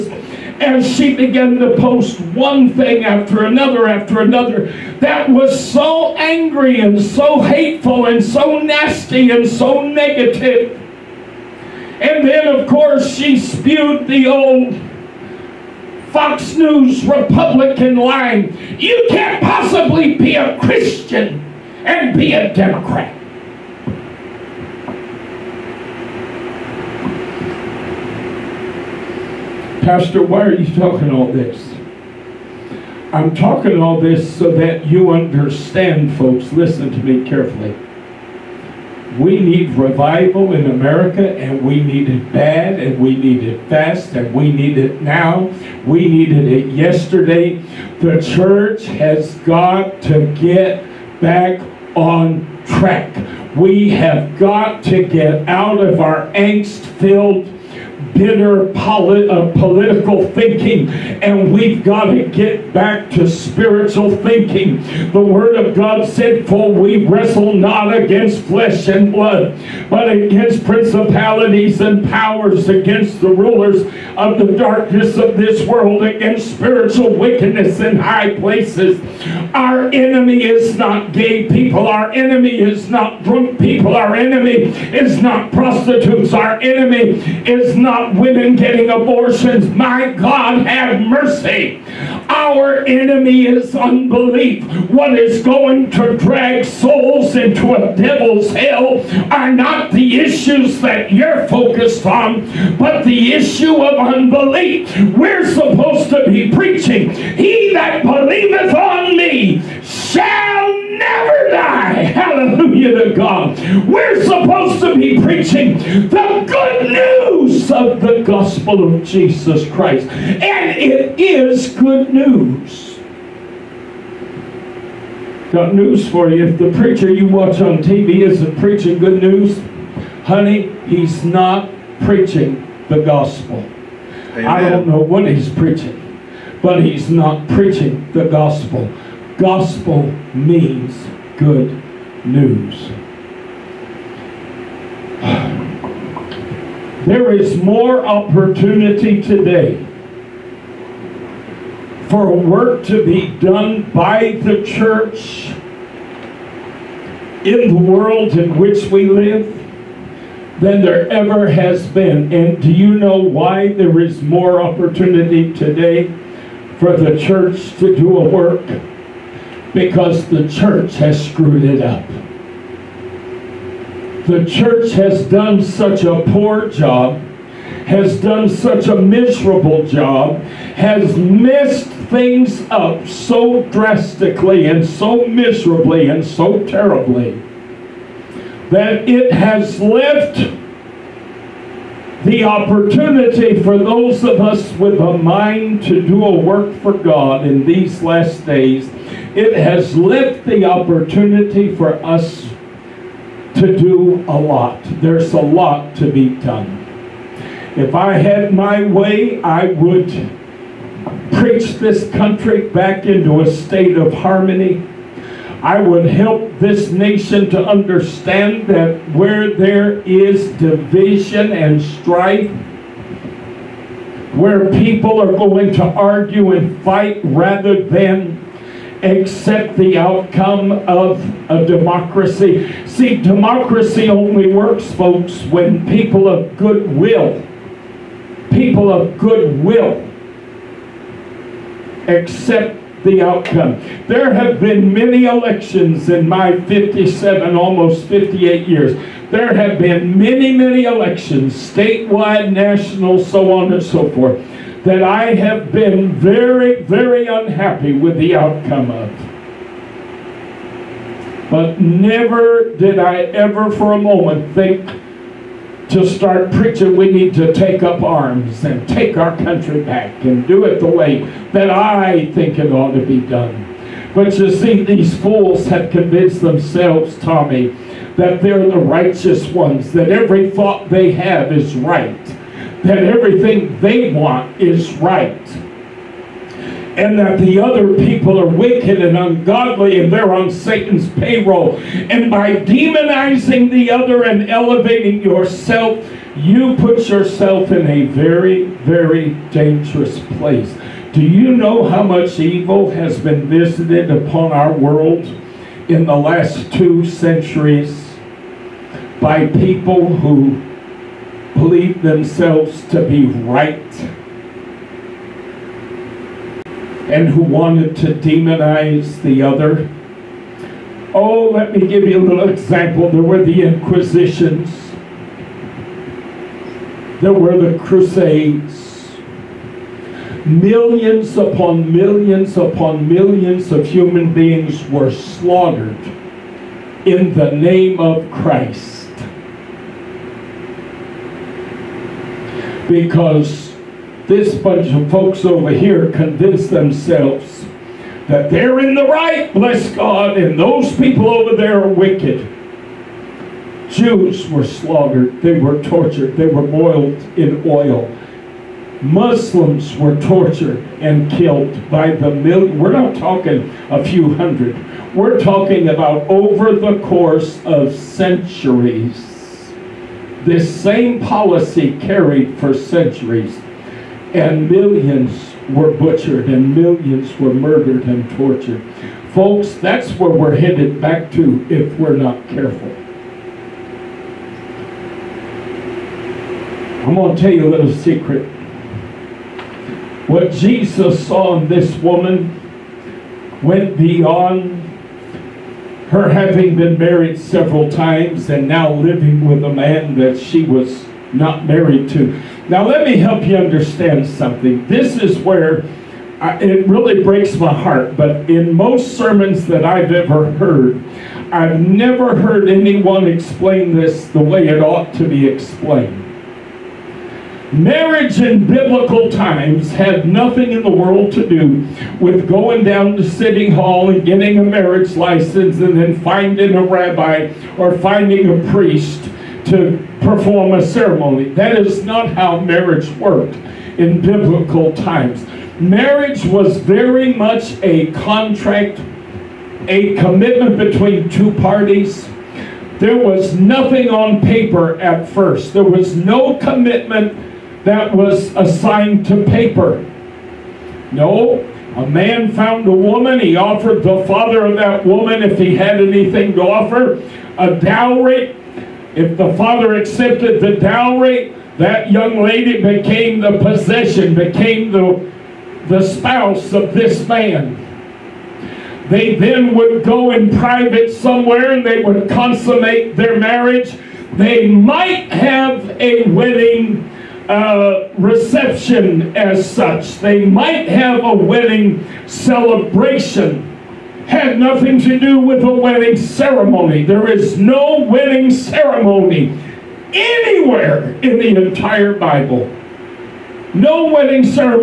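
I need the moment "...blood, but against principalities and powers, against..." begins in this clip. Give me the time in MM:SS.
01:09.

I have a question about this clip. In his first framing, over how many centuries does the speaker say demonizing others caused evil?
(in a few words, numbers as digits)
2.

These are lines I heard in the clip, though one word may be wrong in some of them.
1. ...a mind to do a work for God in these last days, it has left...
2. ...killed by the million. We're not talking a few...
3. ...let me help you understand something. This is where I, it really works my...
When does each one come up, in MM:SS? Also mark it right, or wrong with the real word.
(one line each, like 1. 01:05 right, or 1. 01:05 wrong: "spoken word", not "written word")
1. 03:15 right
2. 06:01 right
3. 06:42 wrong: "breaks", not "works".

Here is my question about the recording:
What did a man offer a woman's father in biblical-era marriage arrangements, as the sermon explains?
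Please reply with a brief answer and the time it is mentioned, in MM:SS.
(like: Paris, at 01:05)
A dowry, at 07:37.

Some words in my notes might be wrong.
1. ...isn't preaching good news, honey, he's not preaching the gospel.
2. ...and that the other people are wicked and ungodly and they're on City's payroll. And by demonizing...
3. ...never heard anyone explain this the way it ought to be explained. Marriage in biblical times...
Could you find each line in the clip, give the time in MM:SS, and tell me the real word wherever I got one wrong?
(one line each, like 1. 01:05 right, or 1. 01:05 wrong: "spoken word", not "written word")
1. 02:08 right
2. 04:46 wrong: "Satan", not "City"
3. 06:51 right.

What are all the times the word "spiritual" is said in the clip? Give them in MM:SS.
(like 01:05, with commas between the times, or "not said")
01:03, 01:16.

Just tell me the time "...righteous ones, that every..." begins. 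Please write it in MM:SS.
04:38.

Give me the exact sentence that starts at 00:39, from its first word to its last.
We need revival in America, and we need it bad, and we need it fast, and we need it now.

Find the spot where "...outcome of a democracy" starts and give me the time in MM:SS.
03:49.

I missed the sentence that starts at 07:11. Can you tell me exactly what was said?
That is not how marriage worked in biblical times.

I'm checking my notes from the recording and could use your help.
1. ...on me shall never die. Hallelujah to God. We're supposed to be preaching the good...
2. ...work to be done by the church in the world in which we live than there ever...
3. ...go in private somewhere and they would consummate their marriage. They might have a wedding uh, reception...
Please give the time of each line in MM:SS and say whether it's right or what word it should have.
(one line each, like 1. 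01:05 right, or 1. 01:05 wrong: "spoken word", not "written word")
1. 01:48 right
2. 02:32 right
3. 07:50 right.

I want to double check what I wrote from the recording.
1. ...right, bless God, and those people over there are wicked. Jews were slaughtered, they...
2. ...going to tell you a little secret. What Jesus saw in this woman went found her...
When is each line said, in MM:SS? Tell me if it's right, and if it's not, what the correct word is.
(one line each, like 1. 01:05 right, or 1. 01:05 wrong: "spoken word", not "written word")
1. 05:49 right
2. 06:27 wrong: "beyond", not "found".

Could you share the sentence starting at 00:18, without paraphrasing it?
You can't possibly be a Christian and be a Democrat.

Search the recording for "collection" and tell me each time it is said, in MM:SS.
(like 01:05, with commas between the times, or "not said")
not said.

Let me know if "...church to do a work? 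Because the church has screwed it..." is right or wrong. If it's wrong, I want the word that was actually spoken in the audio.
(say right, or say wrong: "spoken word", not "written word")
right.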